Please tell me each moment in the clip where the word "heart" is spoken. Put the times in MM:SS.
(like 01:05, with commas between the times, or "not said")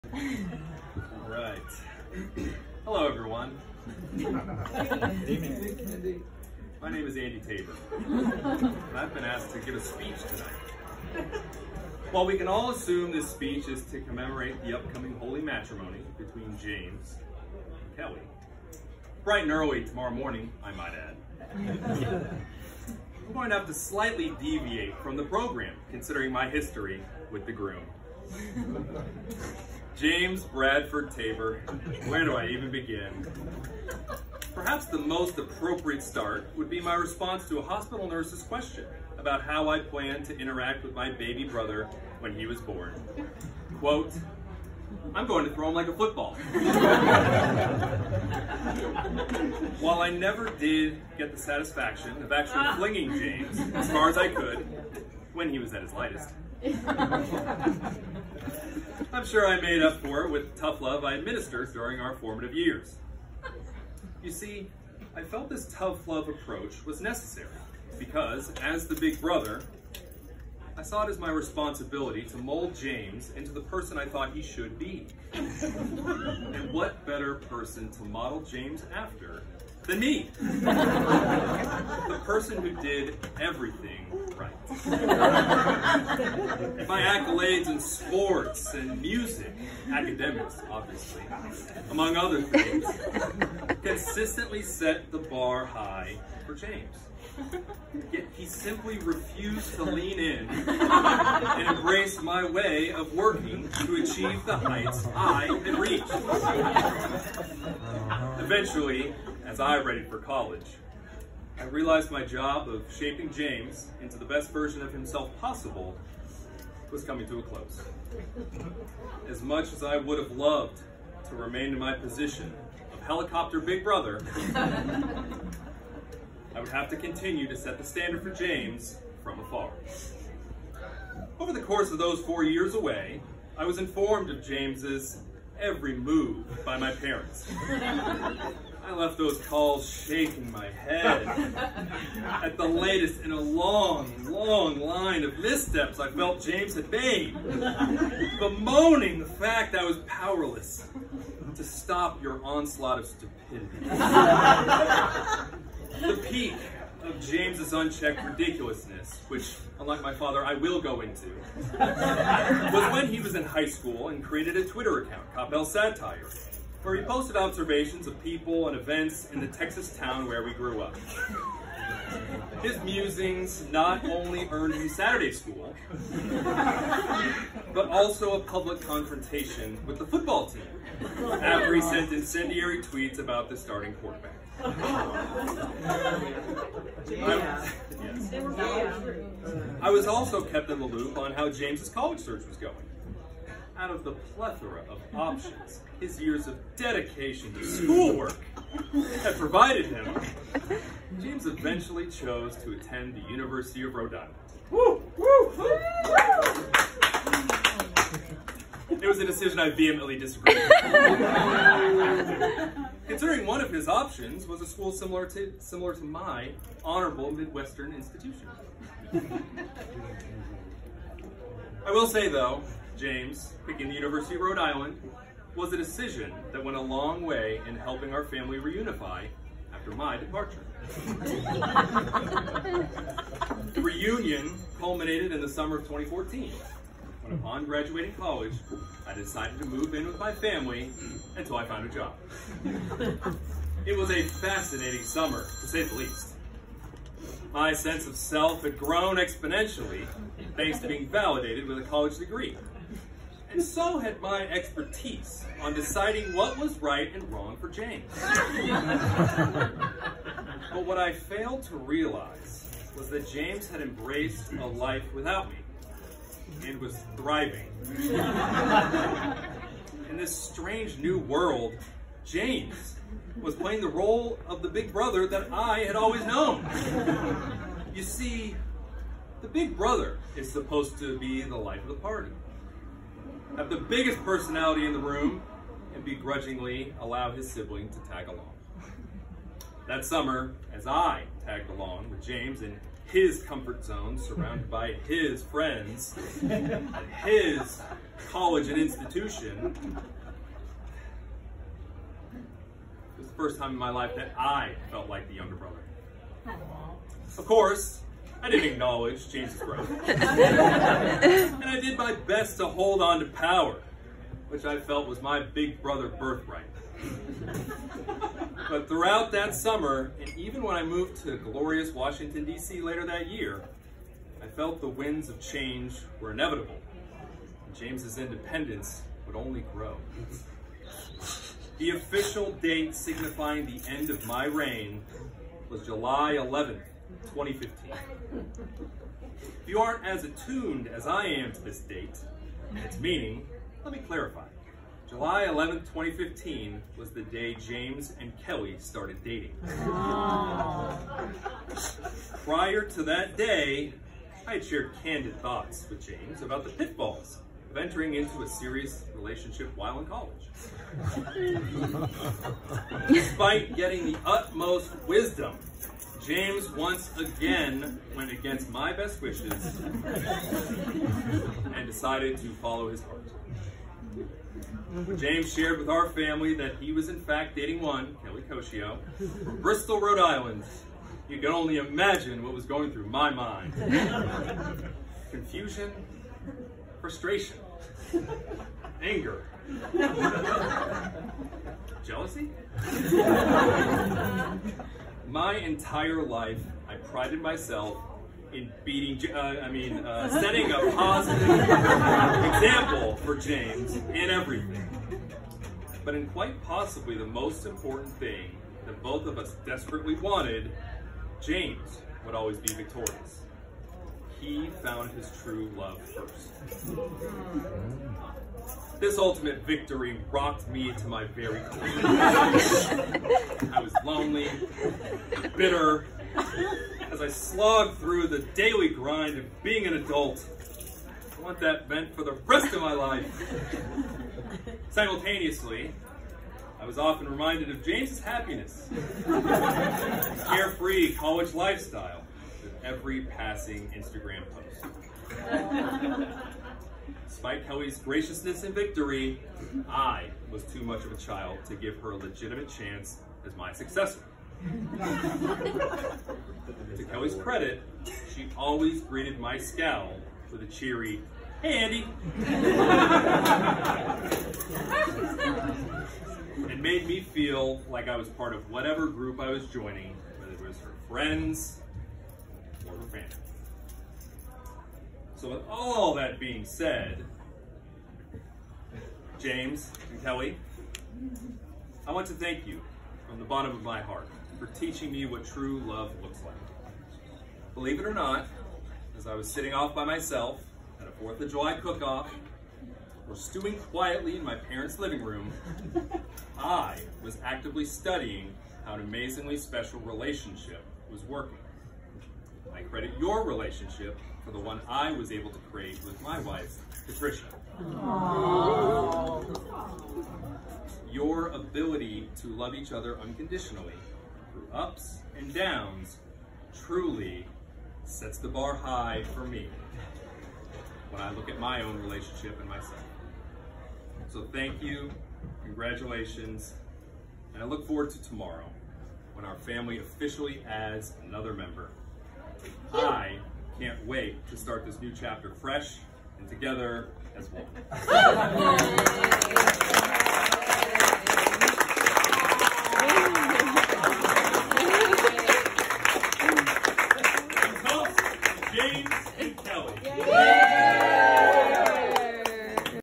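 06:13, 08:04.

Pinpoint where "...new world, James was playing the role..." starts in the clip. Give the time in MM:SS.
04:30.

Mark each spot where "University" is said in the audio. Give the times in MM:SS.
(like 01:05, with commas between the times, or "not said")
03:23, 03:43.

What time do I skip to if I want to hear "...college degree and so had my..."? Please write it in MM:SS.
04:11.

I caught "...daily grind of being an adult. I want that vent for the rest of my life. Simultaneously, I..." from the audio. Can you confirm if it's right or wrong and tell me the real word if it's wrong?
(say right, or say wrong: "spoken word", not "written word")
right.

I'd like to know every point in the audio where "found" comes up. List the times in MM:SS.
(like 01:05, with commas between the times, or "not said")
04:01, 06:54.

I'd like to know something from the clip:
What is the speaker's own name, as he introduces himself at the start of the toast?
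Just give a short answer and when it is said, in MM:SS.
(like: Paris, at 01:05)
Andy Tabor, at 00:07.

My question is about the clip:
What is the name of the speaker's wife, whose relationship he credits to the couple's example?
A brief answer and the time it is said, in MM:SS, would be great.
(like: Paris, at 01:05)
Patricia, at 08:27.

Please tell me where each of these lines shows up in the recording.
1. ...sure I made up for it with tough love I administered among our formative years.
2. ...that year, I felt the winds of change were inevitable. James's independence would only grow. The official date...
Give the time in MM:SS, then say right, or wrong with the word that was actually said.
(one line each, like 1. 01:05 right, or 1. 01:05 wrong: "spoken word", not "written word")
1. 00:59 wrong: "during", not "among"
2. 05:23 right.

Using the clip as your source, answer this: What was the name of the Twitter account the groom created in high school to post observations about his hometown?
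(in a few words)
Coppell Satire.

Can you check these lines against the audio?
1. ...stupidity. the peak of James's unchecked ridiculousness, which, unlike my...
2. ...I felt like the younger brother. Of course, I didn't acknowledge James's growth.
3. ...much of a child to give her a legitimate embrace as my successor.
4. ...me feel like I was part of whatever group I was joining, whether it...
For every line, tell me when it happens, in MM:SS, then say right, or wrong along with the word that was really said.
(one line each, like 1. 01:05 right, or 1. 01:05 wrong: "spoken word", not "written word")
1. 02:33 right
2. 05:04 right
3. 07:30 wrong: "chance", not "embrace"
4. 07:47 right.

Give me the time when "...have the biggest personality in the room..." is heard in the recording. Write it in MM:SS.
04:43.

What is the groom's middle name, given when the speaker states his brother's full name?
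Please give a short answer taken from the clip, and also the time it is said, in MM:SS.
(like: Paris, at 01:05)
Bradford, at 00:30.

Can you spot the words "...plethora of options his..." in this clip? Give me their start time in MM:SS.
03:14.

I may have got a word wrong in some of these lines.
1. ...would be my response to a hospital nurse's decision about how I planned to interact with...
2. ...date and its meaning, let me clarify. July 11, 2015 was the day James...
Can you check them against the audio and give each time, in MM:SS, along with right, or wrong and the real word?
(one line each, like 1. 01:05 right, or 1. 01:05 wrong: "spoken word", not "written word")
1. 00:36 wrong: "question", not "decision"
2. 05:41 right.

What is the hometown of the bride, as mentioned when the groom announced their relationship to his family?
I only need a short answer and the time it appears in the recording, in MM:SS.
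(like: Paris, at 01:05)
Bristol, Rhode Island, at 06:19.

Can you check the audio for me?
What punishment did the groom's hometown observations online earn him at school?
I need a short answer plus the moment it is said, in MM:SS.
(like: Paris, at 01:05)
Saturday school, at 02:54.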